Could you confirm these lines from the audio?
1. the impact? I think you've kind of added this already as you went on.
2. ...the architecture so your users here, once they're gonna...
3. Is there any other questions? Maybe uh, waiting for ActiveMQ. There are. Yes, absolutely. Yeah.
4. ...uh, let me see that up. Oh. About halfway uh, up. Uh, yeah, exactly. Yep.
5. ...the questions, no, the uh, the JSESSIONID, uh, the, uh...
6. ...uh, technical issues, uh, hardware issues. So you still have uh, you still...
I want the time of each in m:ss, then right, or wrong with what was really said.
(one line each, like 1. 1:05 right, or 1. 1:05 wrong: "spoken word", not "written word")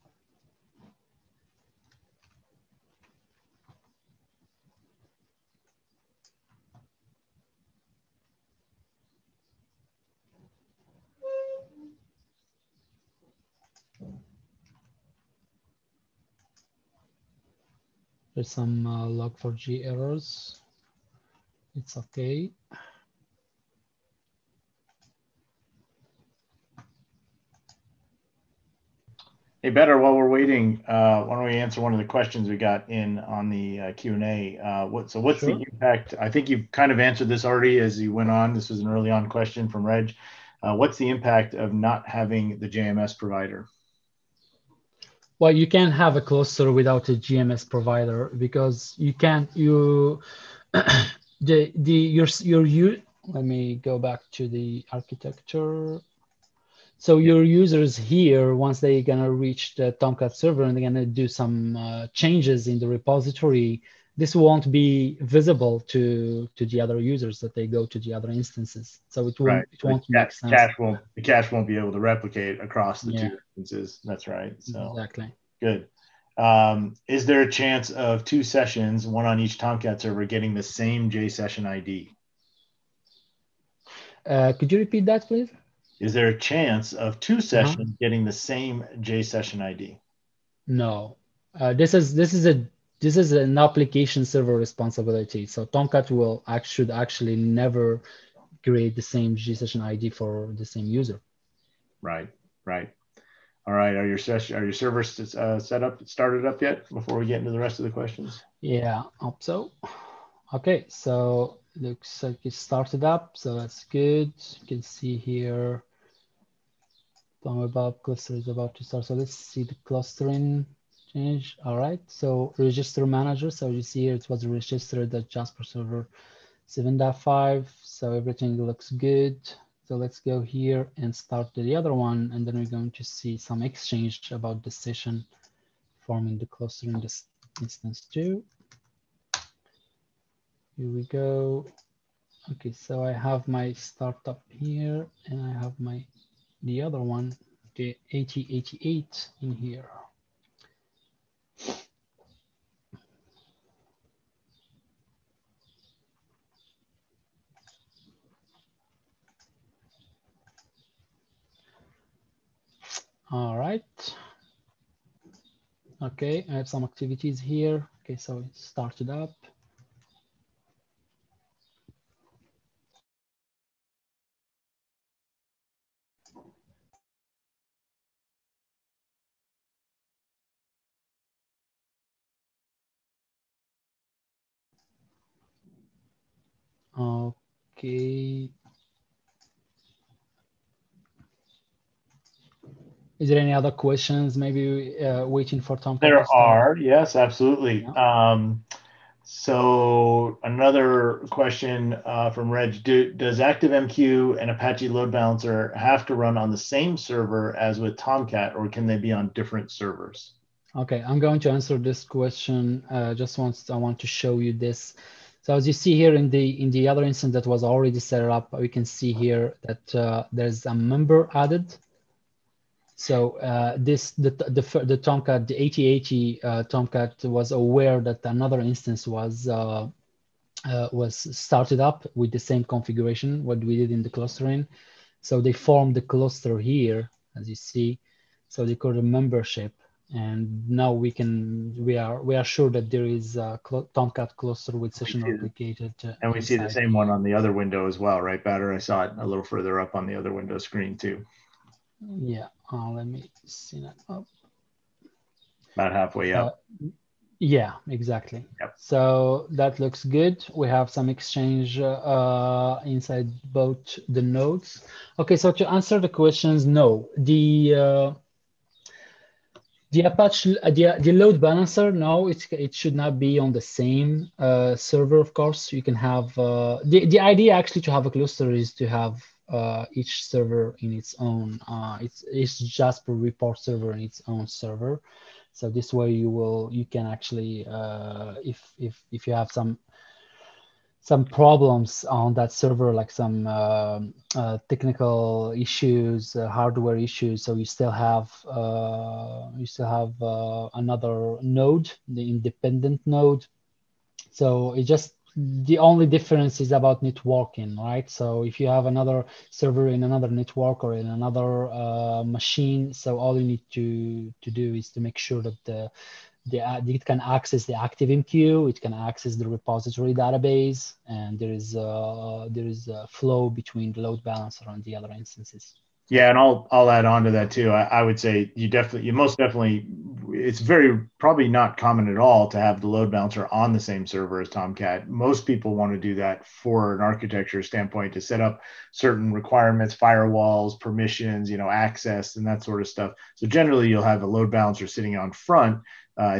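1. 0:35 wrong: "answered", not "added"
2. 0:54 right
3. 3:13 wrong: "Tom", not "ActiveMQ"
4. 4:12 right
5. 4:25 wrong: "Apache", not "JSESSIONID"
6. 4:54 right.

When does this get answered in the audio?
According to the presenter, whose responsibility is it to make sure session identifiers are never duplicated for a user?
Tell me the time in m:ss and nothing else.
1:33.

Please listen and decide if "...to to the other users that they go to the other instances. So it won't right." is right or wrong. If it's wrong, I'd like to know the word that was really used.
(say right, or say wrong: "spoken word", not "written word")
right.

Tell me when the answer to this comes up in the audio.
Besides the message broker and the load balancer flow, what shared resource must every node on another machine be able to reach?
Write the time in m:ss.
5:19.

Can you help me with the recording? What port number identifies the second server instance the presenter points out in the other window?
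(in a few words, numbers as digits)
8088.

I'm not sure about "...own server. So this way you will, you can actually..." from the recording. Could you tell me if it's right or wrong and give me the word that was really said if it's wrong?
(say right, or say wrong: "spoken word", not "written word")
right.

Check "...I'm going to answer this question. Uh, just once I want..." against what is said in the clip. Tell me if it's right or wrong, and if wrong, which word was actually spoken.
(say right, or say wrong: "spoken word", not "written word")
right.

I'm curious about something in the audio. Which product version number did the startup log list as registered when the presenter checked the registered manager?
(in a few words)
7.5.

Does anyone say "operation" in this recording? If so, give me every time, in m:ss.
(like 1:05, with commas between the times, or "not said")
not said.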